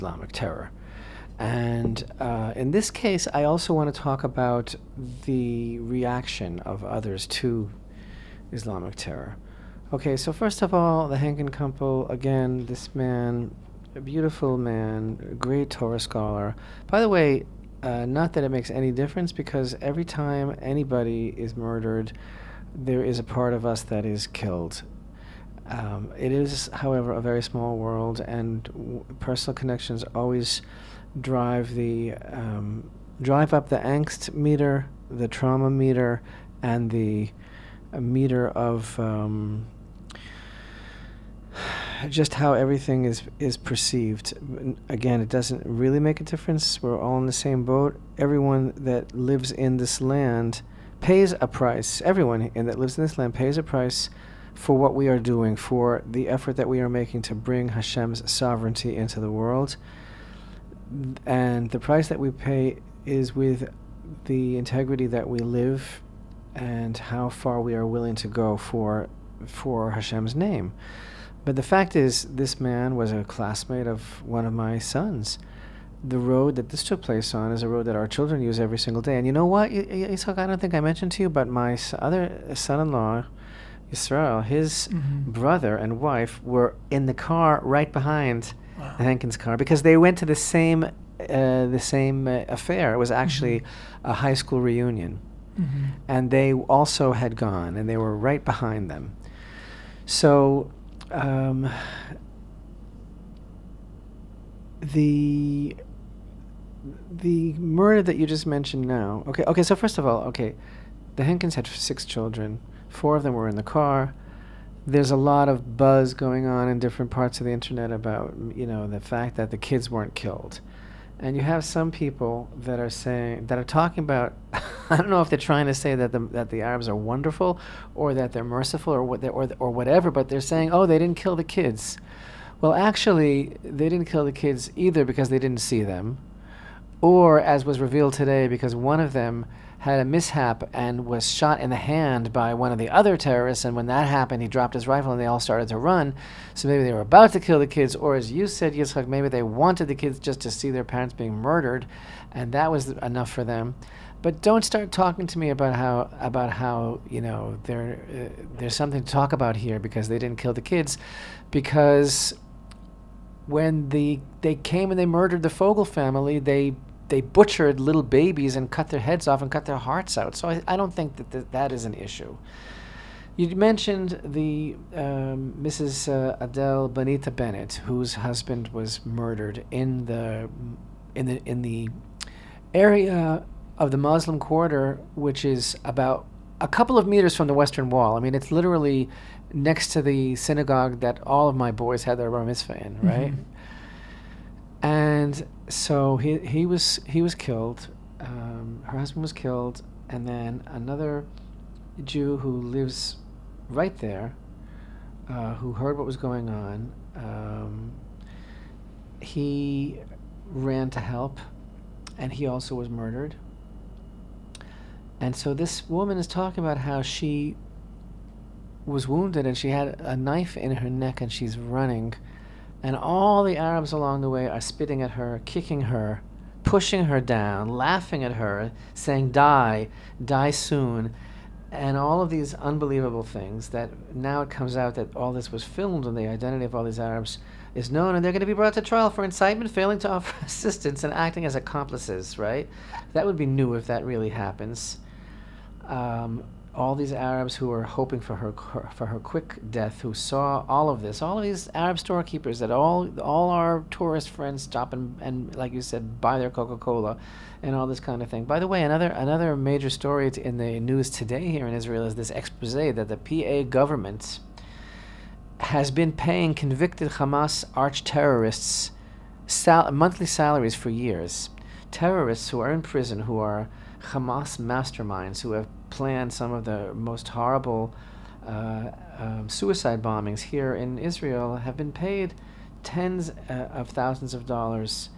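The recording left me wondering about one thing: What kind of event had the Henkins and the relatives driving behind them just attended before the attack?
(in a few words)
high school reunion.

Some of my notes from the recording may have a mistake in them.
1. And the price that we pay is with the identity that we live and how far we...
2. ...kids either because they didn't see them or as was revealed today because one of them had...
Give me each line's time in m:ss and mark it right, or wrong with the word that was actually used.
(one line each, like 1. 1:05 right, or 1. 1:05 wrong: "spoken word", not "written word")
1. 1:01 wrong: "integrity", not "identity"
2. 2:14 right.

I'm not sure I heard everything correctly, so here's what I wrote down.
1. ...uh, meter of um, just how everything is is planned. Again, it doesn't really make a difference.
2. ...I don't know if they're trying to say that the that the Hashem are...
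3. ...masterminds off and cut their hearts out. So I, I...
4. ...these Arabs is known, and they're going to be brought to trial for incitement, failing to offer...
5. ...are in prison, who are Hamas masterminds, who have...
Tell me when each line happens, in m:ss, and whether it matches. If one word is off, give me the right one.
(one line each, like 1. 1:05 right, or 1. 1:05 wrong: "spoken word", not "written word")
1. 0:37 wrong: "perceived", not "planned"
2. 2:04 wrong: "Arabs", not "Hashem"
3. 2:48 wrong: "heads", not "masterminds"
4. 3:56 right
5. 4:32 right.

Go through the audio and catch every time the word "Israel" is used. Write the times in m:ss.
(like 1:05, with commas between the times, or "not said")
1:23, 4:21, 4:40.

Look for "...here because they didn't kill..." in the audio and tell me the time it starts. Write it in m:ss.
2:39.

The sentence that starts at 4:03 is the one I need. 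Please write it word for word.
That would be new if that really happens.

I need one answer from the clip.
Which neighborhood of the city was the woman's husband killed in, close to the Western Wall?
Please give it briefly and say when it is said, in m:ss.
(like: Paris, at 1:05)
the Muslim quarter, at 3:03.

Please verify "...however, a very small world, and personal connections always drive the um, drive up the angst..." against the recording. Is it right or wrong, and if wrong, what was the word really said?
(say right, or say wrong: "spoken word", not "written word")
right.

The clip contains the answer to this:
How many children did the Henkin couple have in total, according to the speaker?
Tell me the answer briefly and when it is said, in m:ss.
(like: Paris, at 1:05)
6, at 1:51.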